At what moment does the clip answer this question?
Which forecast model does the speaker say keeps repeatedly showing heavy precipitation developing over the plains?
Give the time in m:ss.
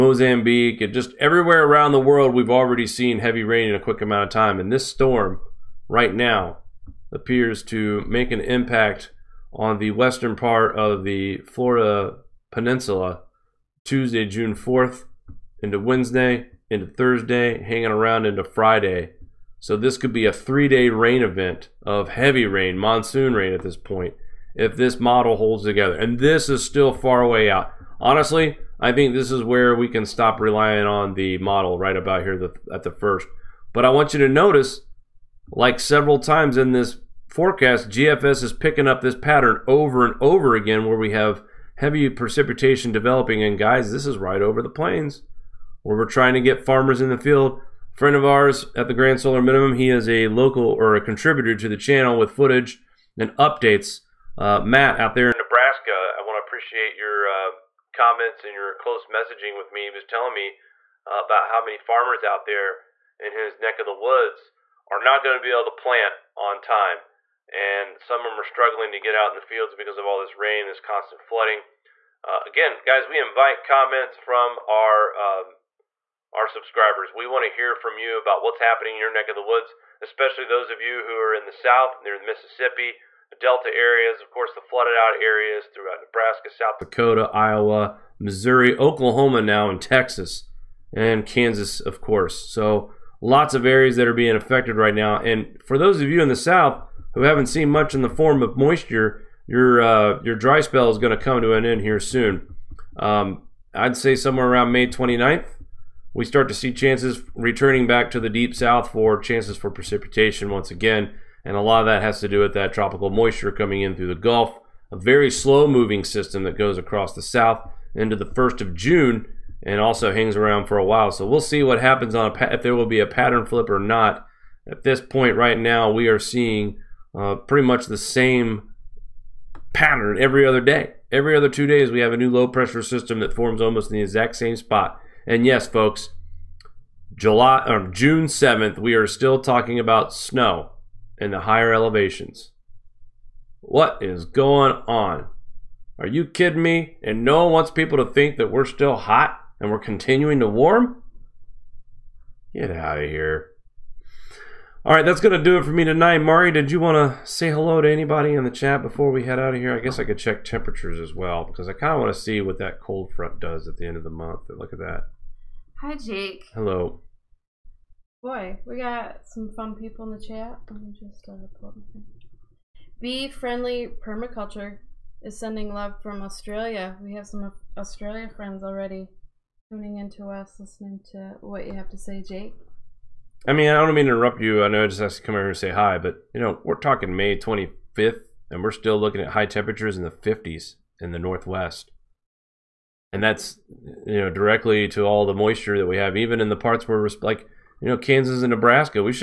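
0:37.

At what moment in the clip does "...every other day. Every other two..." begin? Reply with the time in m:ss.
2:10.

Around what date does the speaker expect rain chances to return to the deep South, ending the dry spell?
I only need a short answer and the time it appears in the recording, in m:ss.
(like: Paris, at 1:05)
May 29, at 1:44.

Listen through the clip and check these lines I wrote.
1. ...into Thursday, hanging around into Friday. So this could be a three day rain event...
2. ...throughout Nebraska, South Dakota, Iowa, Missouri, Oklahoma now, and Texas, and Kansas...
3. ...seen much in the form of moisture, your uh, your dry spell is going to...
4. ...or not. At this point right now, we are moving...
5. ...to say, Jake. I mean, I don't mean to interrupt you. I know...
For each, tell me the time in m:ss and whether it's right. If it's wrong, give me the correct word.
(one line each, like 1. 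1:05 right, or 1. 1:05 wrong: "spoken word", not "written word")
1. 0:16 right
2. 1:25 right
3. 1:37 right
4. 2:03 wrong: "seeing", not "moving"
5. 3:01 right.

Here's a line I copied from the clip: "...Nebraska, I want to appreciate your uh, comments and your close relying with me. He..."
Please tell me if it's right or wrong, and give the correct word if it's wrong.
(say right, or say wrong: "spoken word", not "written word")
wrong: "messaging", not "relying".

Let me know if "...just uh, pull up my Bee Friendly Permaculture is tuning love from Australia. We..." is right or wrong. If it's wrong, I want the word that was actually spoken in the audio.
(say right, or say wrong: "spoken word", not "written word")
wrong: "sending", not "tuning".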